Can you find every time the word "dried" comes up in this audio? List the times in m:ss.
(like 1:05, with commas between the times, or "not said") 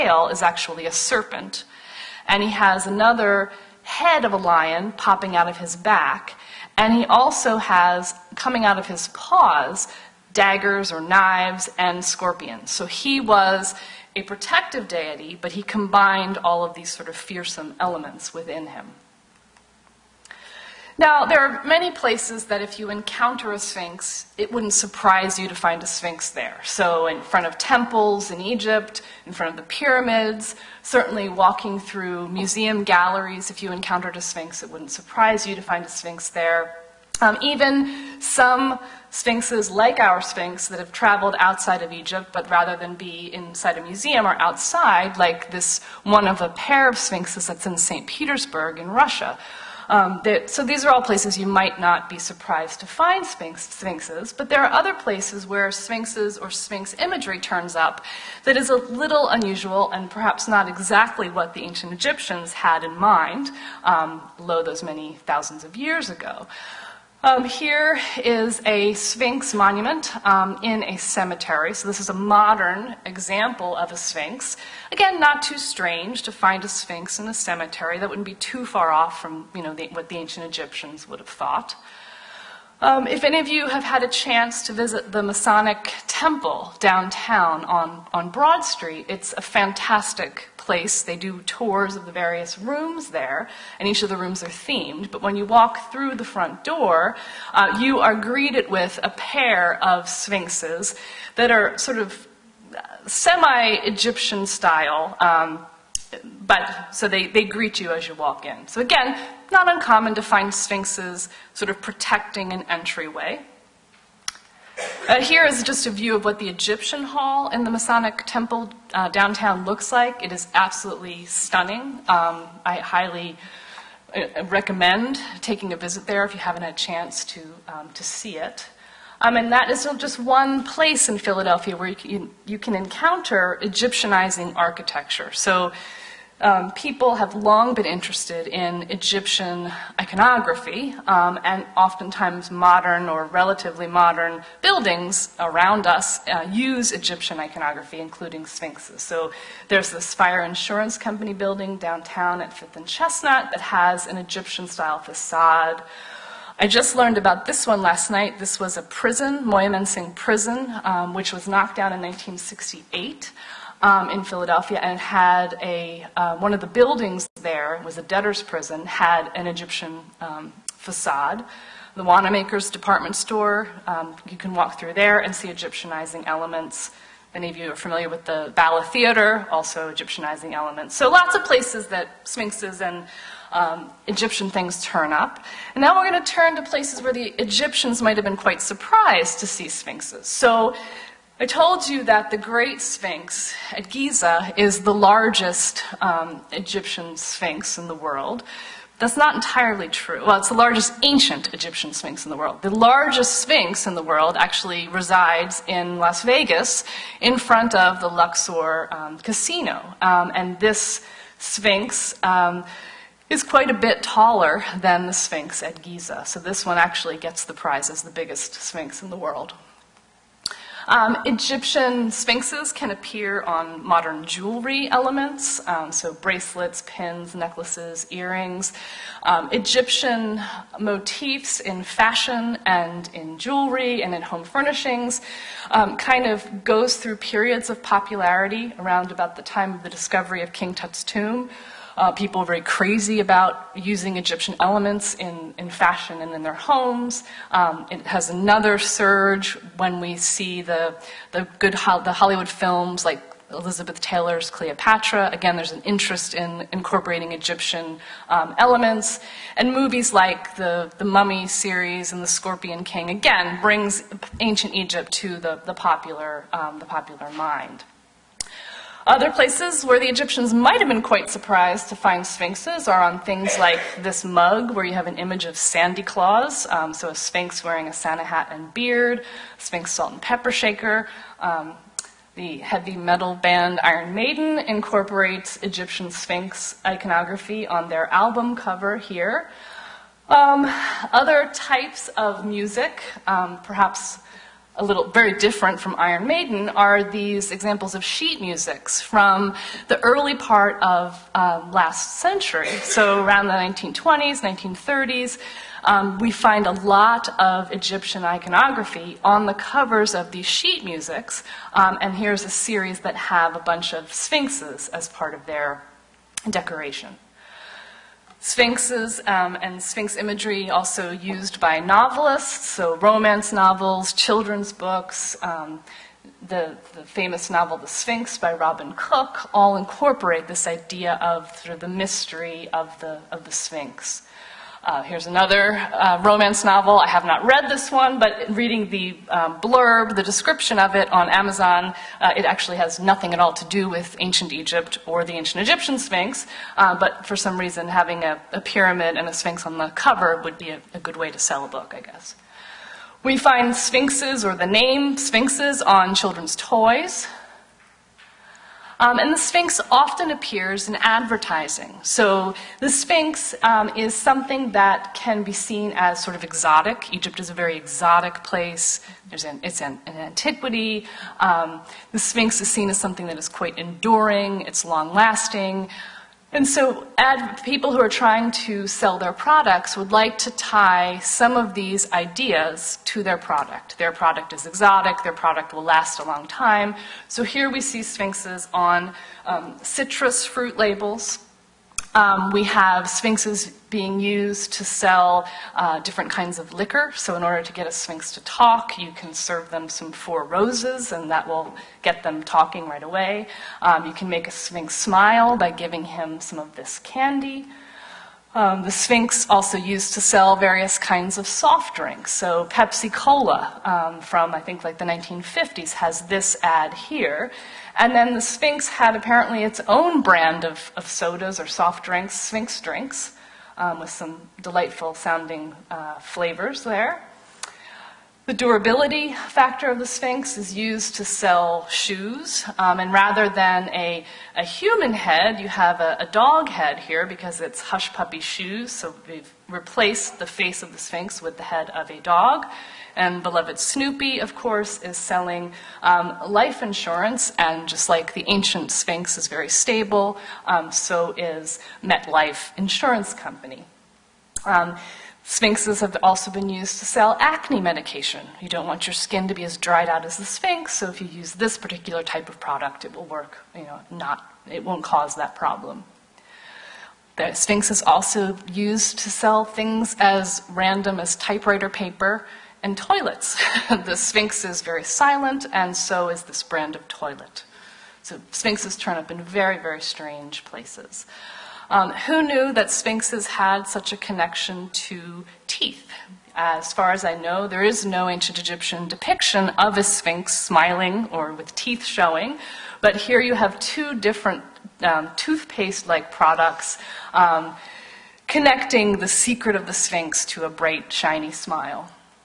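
7:39.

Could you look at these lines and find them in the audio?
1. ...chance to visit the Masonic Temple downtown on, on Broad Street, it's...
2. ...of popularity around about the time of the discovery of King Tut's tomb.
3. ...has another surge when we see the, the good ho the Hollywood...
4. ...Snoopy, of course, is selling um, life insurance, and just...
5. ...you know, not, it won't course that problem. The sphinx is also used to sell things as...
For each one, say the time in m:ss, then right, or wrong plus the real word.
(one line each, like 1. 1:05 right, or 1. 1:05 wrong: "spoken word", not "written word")
1. 1:24 right
2. 3:57 right
3. 4:08 right
4. 7:23 right
5. 7:43 wrong: "cause", not "course".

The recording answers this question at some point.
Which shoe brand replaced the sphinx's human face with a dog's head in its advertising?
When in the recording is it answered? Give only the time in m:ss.
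7:17.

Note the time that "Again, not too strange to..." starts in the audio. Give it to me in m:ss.
1:14.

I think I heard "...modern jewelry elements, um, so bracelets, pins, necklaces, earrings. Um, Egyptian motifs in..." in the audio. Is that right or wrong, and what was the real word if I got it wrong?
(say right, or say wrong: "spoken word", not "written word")
right.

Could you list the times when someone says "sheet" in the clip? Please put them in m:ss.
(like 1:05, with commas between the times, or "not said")
4:58, 5:10.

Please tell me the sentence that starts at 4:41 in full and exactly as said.
Um, the heavy metal band Iron Maiden incorporates Egyptian sphinx iconography on their album cover here.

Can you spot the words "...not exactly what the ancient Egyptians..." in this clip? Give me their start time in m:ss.
1:00.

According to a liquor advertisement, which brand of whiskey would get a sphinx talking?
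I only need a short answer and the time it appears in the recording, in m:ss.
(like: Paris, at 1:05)
Four Roses, at 6:40.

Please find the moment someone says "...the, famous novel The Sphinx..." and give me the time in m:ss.
5:26.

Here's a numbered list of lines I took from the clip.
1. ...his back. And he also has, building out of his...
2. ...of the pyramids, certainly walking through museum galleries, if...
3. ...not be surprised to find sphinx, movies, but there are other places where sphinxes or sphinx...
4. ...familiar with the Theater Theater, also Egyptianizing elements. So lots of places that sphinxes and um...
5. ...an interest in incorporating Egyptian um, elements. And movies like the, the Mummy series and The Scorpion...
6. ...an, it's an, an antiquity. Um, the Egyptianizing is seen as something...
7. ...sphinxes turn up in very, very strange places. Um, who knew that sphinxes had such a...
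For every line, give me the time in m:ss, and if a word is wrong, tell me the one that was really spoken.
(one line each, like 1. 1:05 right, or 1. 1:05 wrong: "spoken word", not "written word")
1. 0:05 wrong: "coming", not "building"
2. 0:29 right
3. 0:51 wrong: "sphinxes", not "movies"
4. 2:57 wrong: "Bala", not "Theater"
5. 4:15 right
6. 6:09 wrong: "Sphinx", not "Egyptianizing"
7. 7:58 right.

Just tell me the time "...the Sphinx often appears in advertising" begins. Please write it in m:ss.
5:59.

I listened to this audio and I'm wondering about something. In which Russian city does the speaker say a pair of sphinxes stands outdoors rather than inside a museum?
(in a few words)
St. Petersburg.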